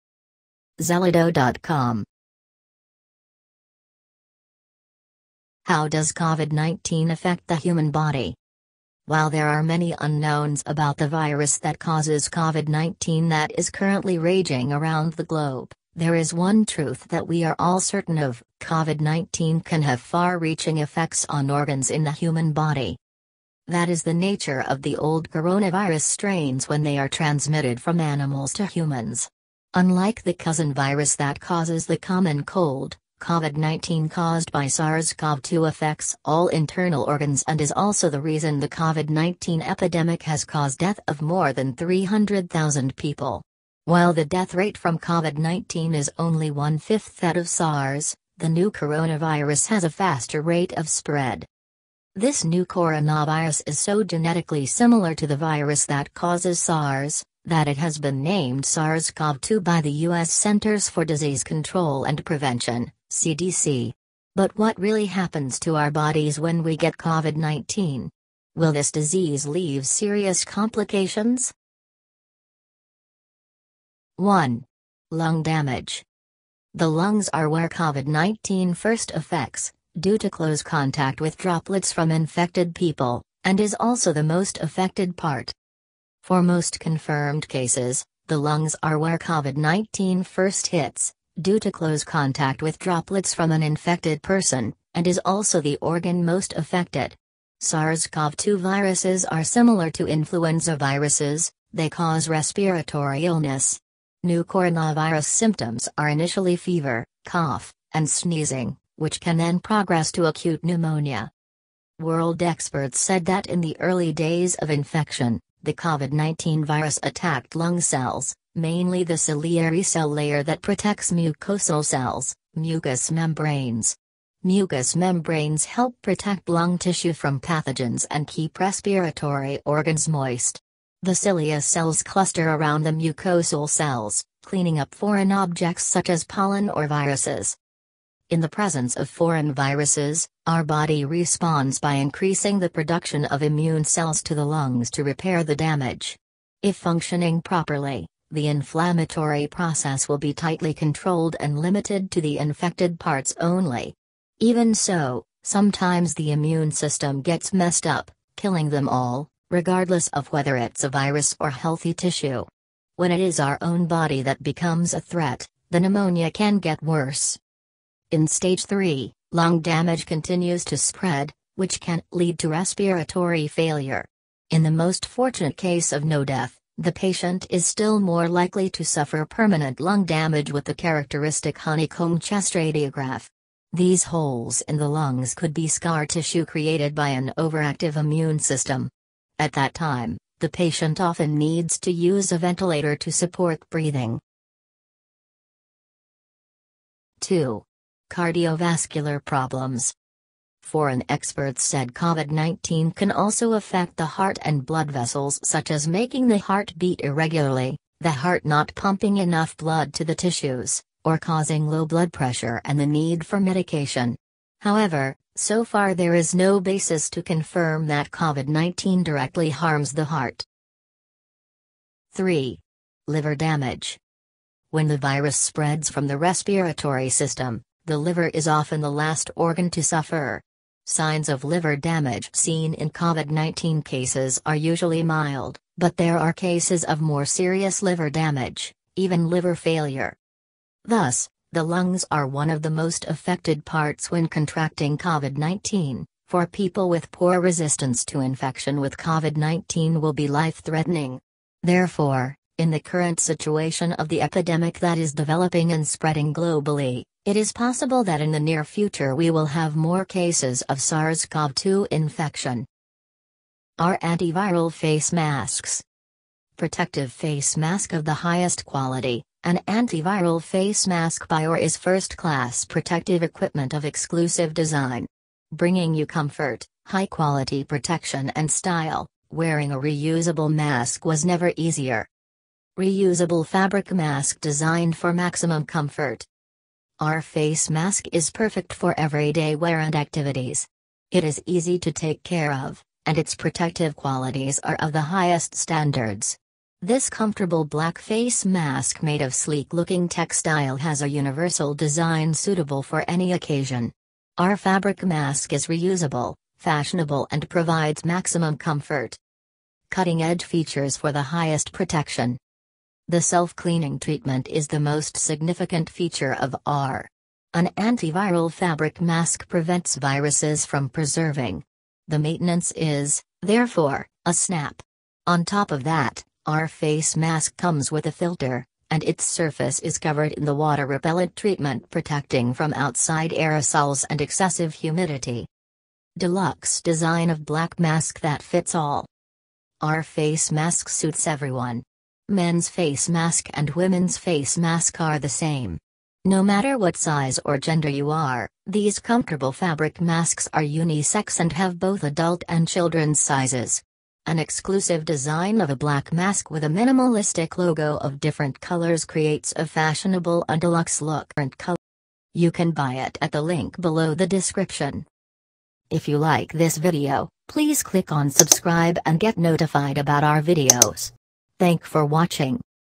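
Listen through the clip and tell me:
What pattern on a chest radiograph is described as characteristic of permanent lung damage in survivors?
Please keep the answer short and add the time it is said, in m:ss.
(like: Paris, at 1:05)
honeycomb, at 3:01.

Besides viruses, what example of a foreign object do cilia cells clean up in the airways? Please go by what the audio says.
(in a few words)
pollen.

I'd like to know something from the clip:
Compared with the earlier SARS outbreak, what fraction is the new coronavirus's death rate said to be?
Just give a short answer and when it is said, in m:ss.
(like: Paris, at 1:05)
one fifth, at 0:46.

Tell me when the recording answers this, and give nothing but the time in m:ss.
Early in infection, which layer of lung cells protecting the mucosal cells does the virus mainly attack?
1:59.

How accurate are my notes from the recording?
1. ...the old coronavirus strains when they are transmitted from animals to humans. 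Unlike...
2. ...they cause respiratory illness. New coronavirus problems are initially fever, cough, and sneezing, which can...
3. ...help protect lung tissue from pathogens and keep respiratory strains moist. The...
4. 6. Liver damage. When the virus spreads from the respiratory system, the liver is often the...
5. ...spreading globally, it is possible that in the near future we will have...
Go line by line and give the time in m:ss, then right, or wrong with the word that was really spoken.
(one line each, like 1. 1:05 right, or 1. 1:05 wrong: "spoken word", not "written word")
1. 0:24 right
2. 1:41 wrong: "symptoms", not "problems"
3. 2:05 wrong: "organs", not "strains"
4. 3:42 wrong: "3", not "6"
5. 4:15 right.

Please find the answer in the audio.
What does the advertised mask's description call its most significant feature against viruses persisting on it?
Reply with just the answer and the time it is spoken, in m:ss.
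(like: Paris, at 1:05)
self-cleaning treatment, at 5:13.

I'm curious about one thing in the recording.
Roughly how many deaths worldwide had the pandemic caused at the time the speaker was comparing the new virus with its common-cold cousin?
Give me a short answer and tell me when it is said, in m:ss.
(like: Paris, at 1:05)
300,000, at 0:41.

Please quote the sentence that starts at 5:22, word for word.
The maintenance is, therefore, a snap.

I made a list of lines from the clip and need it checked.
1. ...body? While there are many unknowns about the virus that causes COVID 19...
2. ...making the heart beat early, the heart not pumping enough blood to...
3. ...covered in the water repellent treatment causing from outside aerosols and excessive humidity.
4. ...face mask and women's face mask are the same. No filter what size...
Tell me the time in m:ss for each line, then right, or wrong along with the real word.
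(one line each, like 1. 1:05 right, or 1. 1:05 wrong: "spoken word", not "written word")
1. 0:07 right
2. 3:25 wrong: "irregularly", not "early"
3. 5:29 wrong: "protecting", not "causing"
4. 5:42 wrong: "matter", not "filter".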